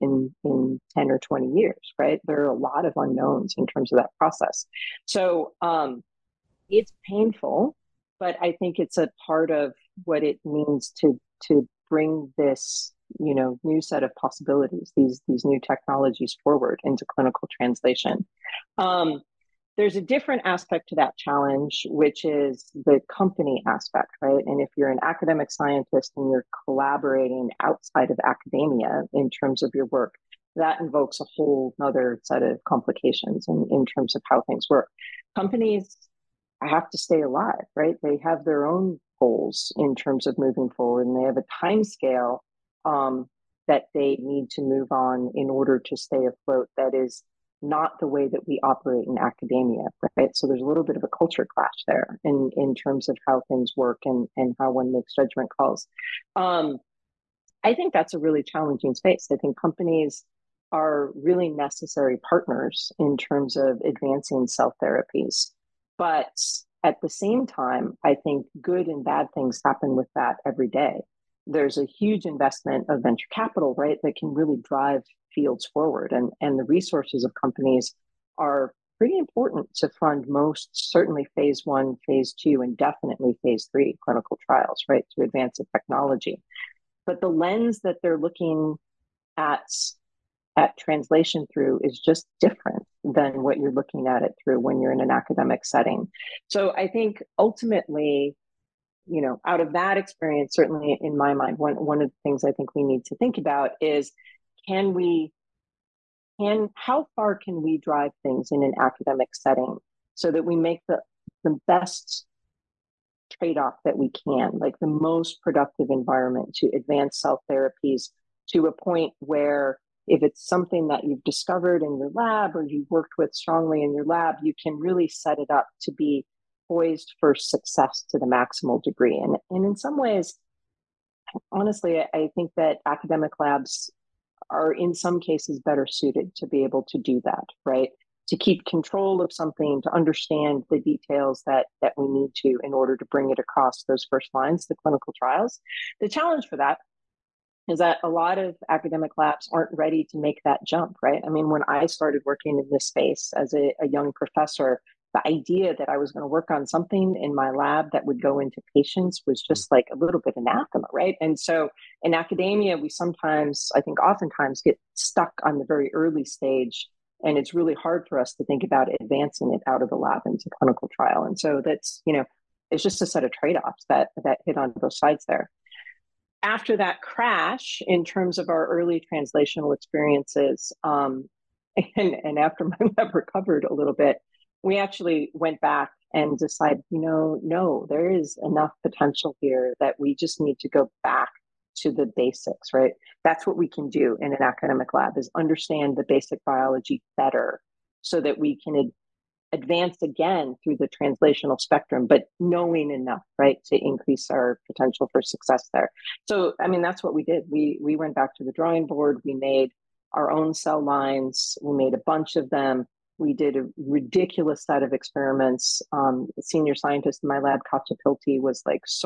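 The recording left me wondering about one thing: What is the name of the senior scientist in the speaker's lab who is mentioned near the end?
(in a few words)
Katja Piltti.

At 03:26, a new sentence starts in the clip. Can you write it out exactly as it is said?
So, I mean, that's what we did.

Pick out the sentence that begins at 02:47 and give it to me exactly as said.
And it's really hard for us to think about advancing it out of the lab into clinical trial.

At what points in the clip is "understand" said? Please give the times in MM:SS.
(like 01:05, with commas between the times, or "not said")
02:19, 03:15.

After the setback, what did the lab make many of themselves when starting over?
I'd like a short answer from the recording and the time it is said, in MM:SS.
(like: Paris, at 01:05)
Cell lines, at 03:30.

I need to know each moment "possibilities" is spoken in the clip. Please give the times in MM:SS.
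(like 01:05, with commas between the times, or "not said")
00:14.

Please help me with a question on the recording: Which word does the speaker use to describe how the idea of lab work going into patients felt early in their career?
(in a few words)
Anathema.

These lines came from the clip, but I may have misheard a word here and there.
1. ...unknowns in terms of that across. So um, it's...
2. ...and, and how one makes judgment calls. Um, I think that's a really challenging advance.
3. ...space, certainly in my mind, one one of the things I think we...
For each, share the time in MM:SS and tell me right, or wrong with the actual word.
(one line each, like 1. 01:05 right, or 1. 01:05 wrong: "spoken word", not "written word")
1. 00:02 wrong: "process", not "across"
2. 00:54 wrong: "space", not "advance"
3. 01:39 wrong: "experience", not "space".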